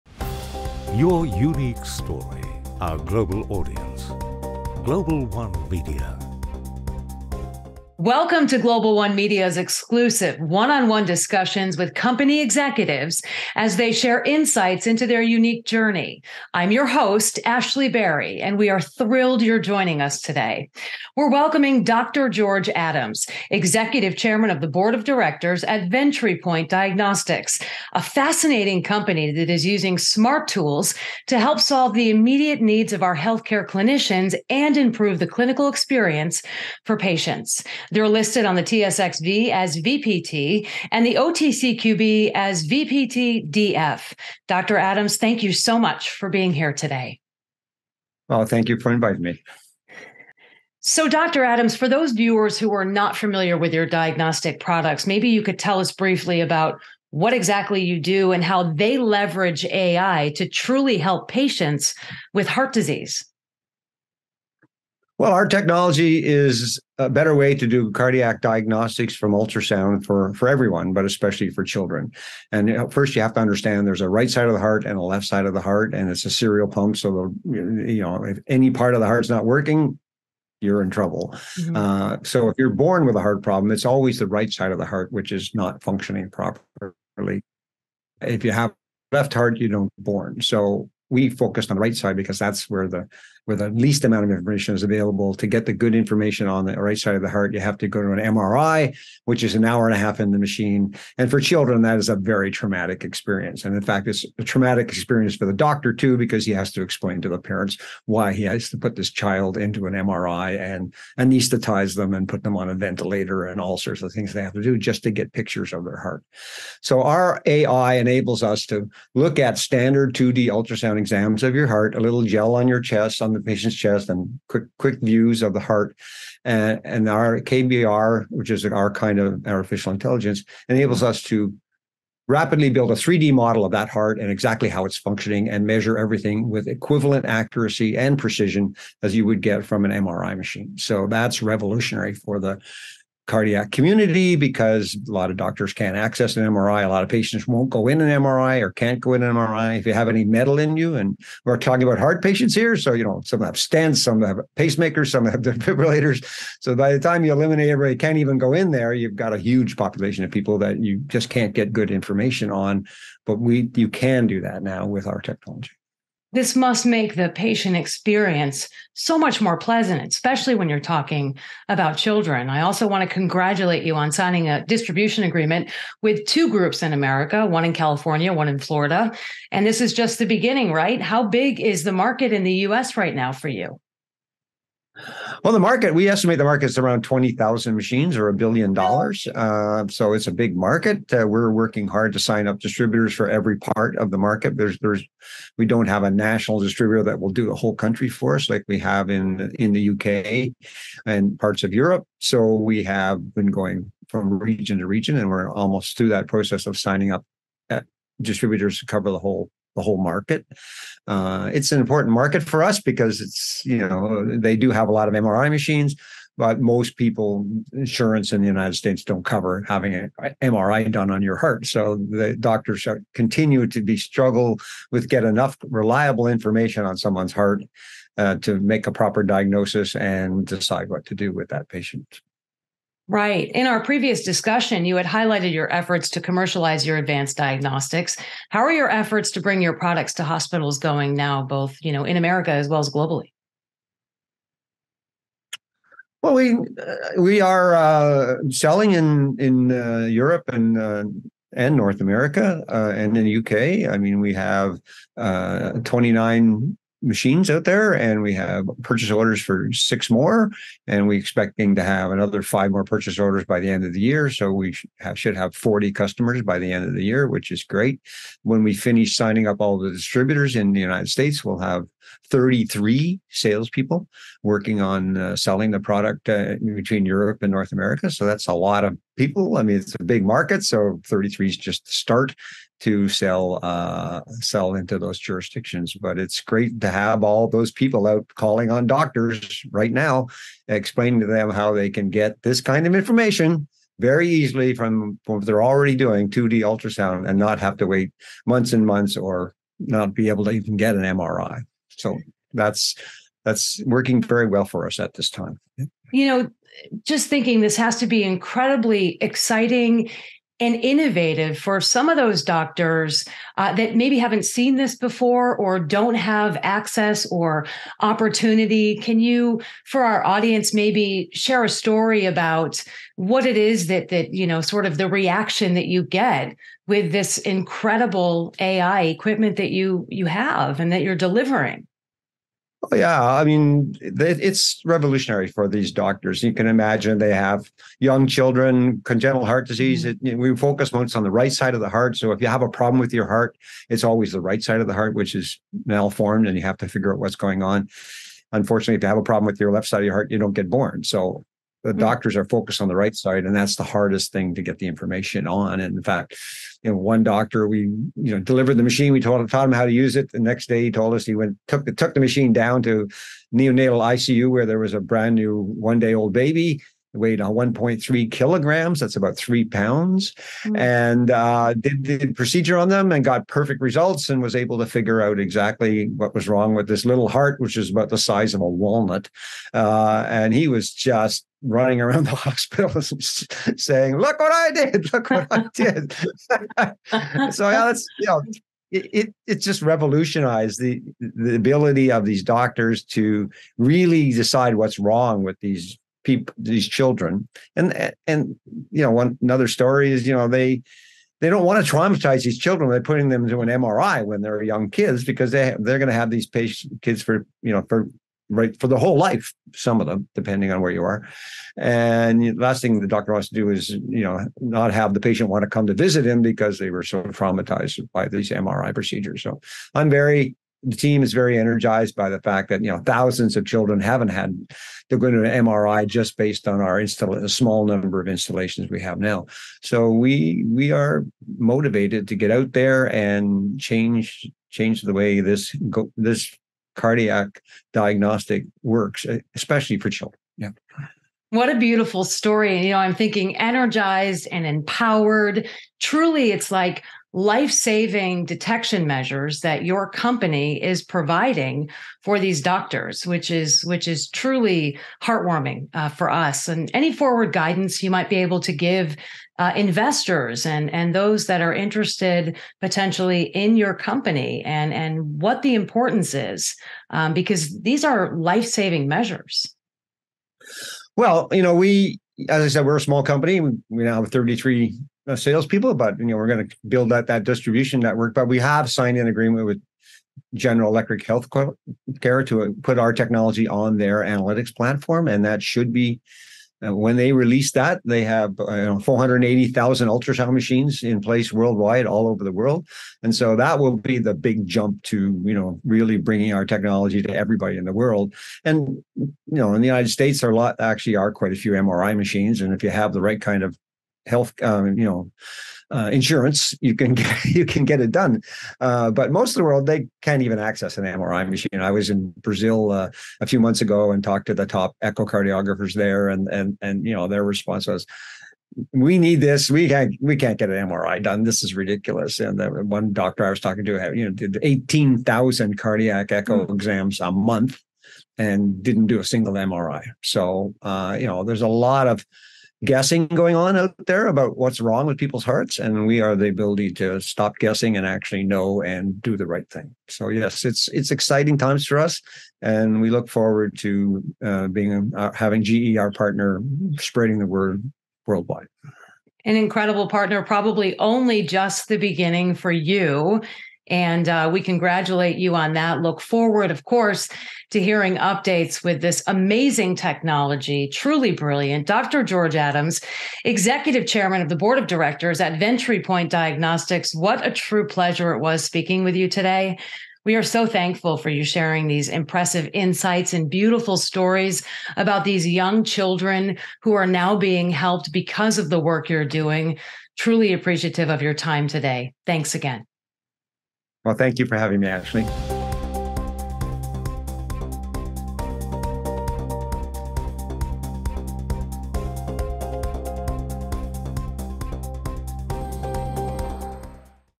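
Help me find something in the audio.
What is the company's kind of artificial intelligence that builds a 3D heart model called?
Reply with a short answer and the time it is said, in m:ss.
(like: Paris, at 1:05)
KBR, at 2:07.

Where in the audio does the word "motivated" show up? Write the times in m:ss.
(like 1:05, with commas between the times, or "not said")
7:11.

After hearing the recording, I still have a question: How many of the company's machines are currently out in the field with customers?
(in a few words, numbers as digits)
29.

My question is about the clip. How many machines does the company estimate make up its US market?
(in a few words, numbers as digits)
20,000.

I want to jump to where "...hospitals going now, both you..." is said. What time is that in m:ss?
4:00.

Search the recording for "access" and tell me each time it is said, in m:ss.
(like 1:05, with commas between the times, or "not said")
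2:25, 5:16, 8:30.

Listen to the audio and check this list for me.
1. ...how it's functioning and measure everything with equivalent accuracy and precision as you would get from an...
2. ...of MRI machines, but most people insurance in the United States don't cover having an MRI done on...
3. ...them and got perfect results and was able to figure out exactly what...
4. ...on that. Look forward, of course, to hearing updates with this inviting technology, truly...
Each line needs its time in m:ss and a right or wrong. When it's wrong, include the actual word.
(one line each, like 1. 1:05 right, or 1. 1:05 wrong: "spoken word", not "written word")
1. 2:14 right
2. 3:35 right
3. 6:12 right
4. 9:15 wrong: "amazing", not "inviting".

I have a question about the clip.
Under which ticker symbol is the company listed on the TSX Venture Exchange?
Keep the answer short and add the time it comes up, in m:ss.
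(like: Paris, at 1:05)
VPT, at 0:39.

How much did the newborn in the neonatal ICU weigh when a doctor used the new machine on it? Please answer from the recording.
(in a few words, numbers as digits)
1.3 kilograms.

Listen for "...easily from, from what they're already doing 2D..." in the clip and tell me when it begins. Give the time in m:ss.
4:54.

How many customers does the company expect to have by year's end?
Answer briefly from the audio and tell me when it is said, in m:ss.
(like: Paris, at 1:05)
40, at 4:25.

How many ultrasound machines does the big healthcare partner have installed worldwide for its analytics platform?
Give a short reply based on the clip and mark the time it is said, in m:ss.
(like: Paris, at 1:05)
480,000, at 8:08.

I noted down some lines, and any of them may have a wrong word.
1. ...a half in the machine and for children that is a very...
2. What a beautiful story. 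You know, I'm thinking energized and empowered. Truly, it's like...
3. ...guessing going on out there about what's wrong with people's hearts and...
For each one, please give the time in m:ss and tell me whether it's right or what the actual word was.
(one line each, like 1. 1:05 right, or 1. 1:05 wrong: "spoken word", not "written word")
1. 1:39 right
2. 7:21 right
3. 8:52 right.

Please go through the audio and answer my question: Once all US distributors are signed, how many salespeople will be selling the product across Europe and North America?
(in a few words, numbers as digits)
33.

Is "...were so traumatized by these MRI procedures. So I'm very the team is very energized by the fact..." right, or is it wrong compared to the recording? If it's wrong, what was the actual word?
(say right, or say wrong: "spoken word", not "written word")
right.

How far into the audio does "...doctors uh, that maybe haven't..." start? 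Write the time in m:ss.
5:12.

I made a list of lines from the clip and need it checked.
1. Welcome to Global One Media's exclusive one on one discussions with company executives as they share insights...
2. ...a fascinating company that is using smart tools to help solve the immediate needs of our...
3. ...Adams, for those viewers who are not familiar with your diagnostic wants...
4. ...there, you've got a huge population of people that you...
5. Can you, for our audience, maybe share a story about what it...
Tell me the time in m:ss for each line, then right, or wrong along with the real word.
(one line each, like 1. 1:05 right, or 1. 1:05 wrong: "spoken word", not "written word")
1. 0:08 right
2. 0:27 right
3. 0:51 wrong: "products", not "wants"
4. 2:38 right
5. 5:18 right.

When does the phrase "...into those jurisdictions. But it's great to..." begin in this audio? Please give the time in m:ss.
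4:44.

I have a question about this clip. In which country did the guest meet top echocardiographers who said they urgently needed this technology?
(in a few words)
Brazil.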